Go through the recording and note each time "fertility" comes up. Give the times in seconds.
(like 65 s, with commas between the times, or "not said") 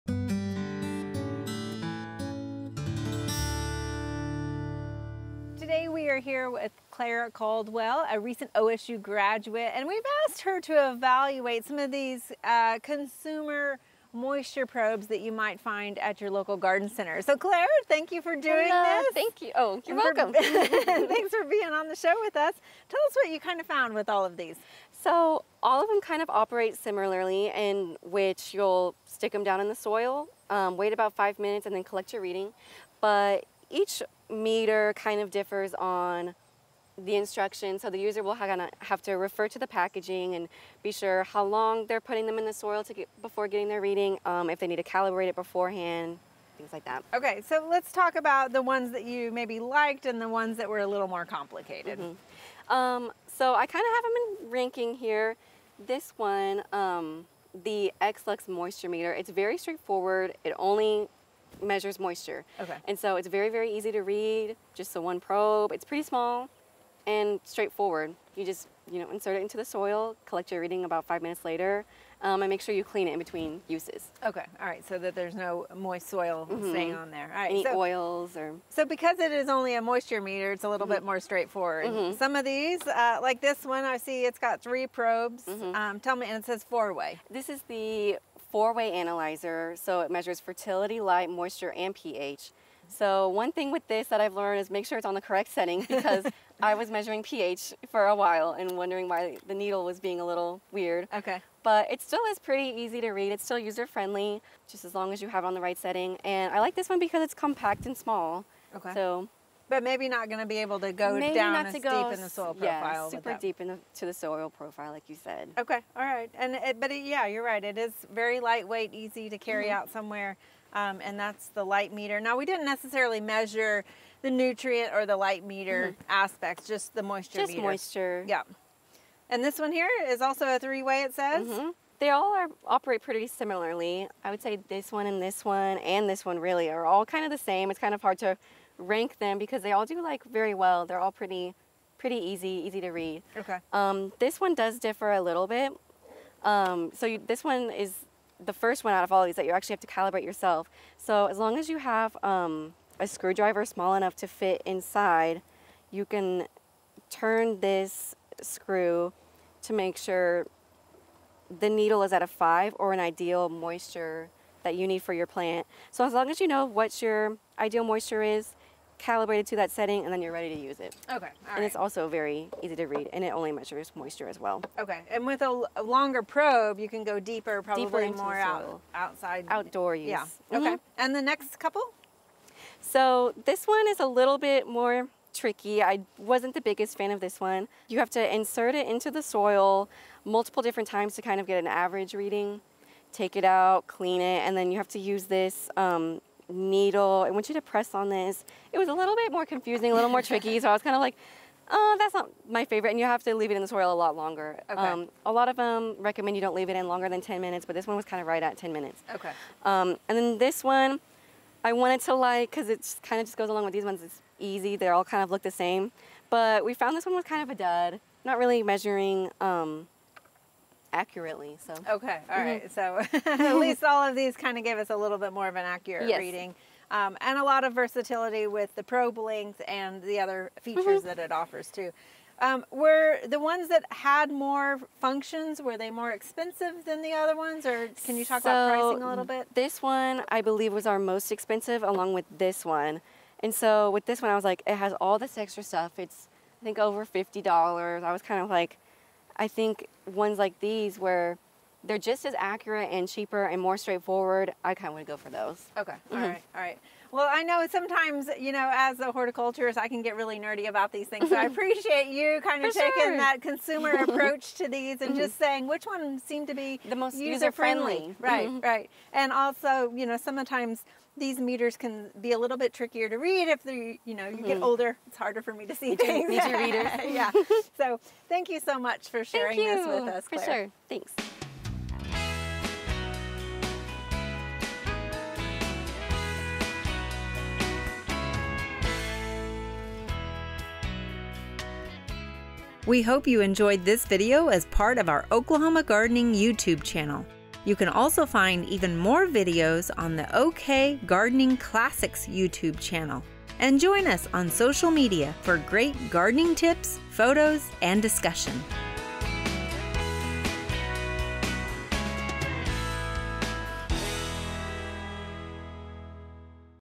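90 s.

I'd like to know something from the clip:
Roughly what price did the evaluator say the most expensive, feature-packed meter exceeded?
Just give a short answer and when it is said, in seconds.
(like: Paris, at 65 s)
$50, at 246 s.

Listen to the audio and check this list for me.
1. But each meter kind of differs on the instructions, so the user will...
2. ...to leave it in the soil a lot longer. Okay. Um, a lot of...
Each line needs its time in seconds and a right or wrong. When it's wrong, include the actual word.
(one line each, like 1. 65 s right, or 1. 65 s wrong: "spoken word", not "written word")
1. 32 s right
2. 203 s right.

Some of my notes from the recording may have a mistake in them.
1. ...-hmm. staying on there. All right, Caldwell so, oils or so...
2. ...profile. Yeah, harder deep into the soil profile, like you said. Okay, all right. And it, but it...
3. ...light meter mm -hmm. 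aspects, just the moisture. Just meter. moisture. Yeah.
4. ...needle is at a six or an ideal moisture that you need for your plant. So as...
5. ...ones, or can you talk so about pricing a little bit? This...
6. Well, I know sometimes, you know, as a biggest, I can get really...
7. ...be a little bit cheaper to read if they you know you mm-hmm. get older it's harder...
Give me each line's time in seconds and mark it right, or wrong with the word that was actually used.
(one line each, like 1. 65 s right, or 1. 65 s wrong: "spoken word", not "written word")
1. 76 s wrong: "Any", not "Caldwell"
2. 112 s wrong: "super", not "harder"
3. 125 s right
4. 161 s wrong: "five", not "six"
5. 237 s right
6. 257 s wrong: "horticulturist", not "biggest"
7. 272 s wrong: "trickier", not "cheaper".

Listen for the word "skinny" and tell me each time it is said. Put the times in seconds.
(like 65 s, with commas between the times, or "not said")
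not said.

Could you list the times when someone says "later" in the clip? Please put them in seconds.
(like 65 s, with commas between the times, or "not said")
71 s.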